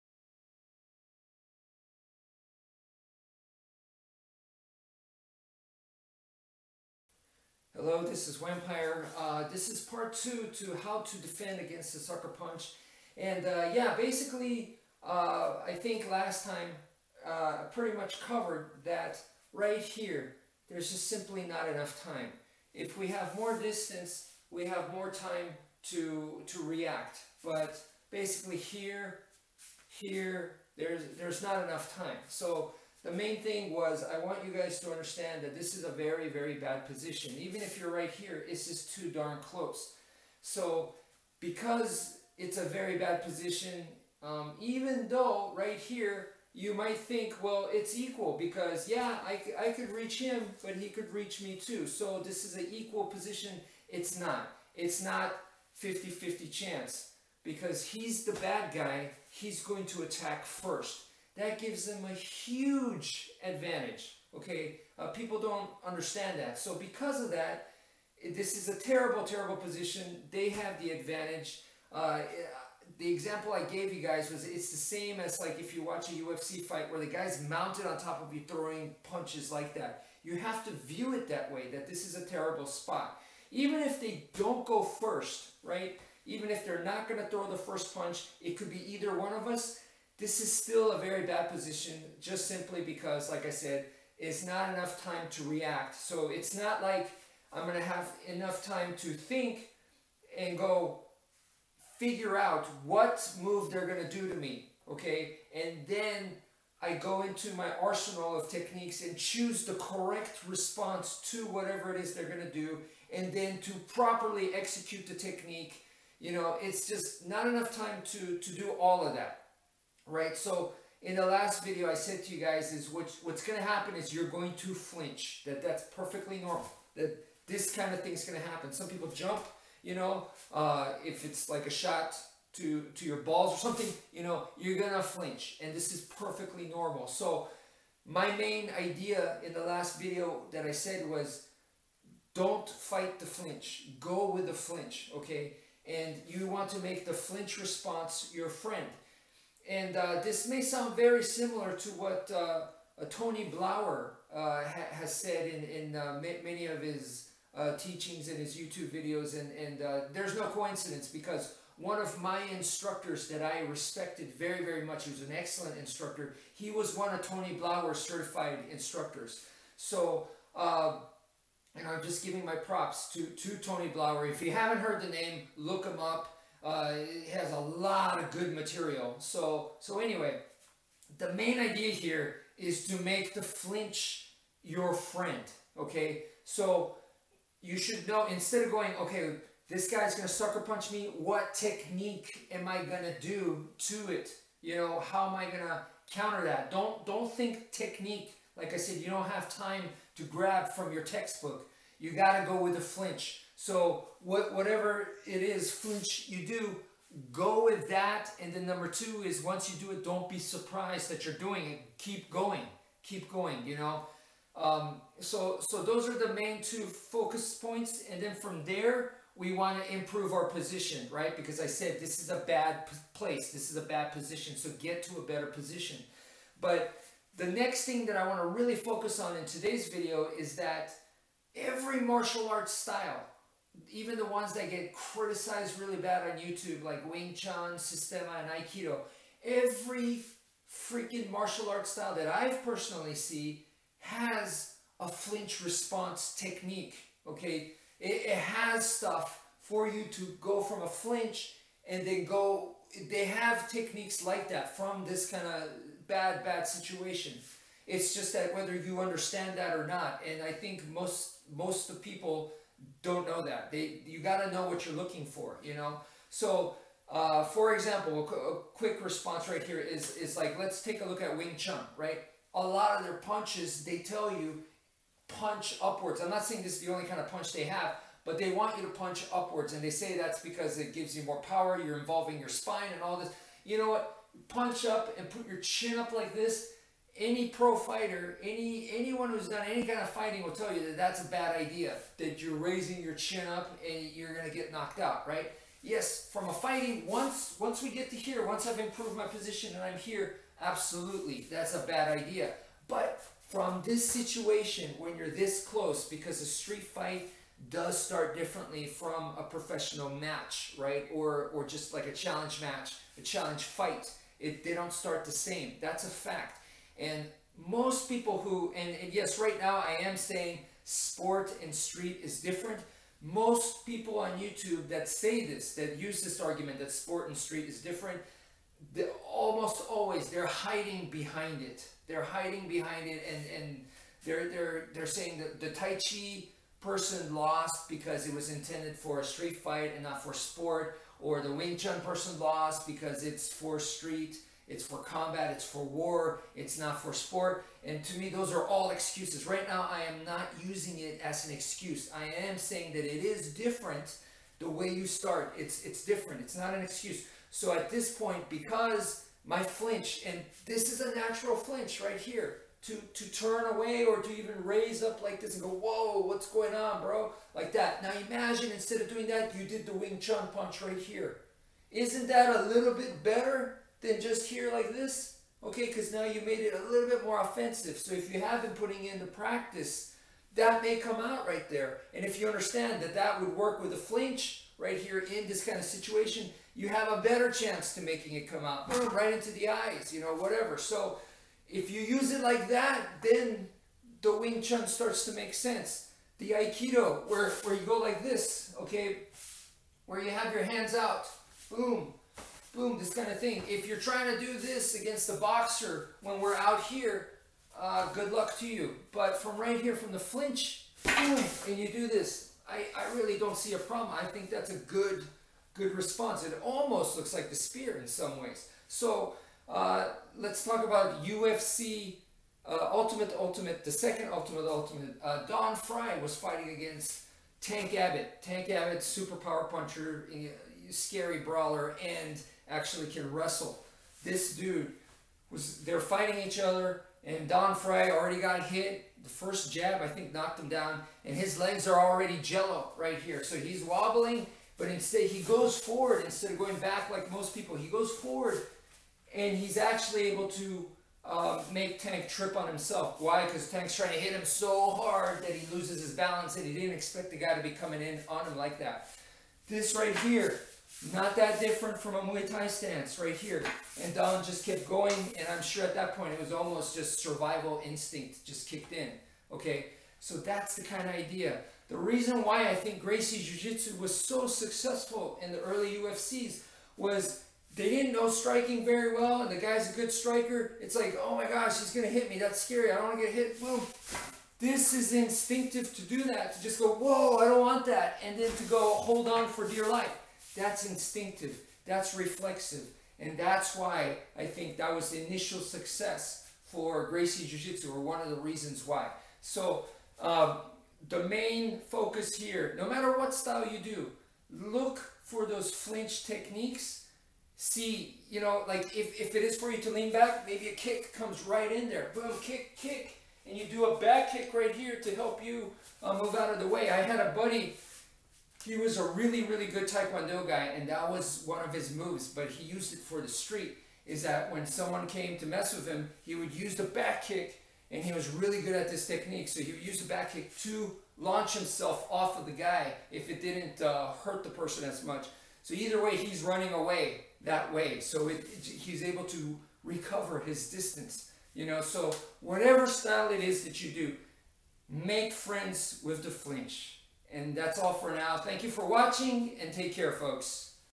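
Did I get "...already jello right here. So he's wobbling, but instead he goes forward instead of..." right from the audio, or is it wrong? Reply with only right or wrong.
right.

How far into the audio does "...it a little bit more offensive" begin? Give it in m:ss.
6:16.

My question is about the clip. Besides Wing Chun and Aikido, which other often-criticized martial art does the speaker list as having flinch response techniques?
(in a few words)
Systema.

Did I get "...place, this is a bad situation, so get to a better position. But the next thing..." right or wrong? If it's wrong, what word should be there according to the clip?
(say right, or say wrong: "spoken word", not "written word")
wrong: "position", not "situation".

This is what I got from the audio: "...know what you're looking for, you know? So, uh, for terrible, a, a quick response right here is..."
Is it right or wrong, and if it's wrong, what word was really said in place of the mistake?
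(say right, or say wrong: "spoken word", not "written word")
wrong: "example", not "terrible".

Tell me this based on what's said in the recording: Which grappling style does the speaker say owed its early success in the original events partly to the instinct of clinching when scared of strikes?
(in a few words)
Gracie Jiu-Jitsu.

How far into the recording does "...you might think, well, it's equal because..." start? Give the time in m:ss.
0:46.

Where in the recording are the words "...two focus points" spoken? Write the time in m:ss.
3:36.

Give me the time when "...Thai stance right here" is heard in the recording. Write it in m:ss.
7:42.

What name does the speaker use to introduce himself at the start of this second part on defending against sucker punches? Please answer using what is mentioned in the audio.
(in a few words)
Vampire.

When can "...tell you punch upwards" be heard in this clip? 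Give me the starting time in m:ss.
4:33.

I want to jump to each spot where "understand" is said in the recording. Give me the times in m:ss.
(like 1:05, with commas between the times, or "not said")
0:34, 1:05, 4:19, 6:22.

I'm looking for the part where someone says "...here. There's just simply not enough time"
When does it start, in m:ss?
0:19.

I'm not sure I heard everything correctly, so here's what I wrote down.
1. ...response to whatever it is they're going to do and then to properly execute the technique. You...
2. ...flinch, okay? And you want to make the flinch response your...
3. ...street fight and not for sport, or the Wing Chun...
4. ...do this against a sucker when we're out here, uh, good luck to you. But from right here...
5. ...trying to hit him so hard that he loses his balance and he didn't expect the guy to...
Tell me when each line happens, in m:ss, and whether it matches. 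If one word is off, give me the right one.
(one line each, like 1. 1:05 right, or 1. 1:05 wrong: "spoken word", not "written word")
1. 1:50 right
2. 2:24 right
3. 5:39 right
4. 6:44 wrong: "boxer", not "sucker"
5. 7:33 right.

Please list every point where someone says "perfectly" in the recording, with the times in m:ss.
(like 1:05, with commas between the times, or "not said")
2:05, 2:16.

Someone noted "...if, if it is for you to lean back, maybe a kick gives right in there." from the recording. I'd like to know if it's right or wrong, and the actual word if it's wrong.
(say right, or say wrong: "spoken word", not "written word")
wrong: "comes", not "gives".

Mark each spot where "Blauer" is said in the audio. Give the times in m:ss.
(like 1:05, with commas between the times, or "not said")
2:33, 2:47, 2:53.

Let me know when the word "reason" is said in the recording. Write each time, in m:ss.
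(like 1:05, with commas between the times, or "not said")
7:51, 8:18.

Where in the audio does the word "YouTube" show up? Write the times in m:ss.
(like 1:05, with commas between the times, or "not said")
2:38, 3:56, 5:24.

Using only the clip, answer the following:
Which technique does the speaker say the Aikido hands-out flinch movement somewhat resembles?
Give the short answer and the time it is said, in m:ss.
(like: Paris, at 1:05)
the spear, at 6:57.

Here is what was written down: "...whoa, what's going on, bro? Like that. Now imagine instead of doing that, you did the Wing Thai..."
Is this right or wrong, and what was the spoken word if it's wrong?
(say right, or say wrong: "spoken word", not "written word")
wrong: "Chun", not "Thai".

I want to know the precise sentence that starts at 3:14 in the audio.
You know, how am I gonna counter that?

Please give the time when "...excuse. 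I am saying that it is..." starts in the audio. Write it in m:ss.
5:51.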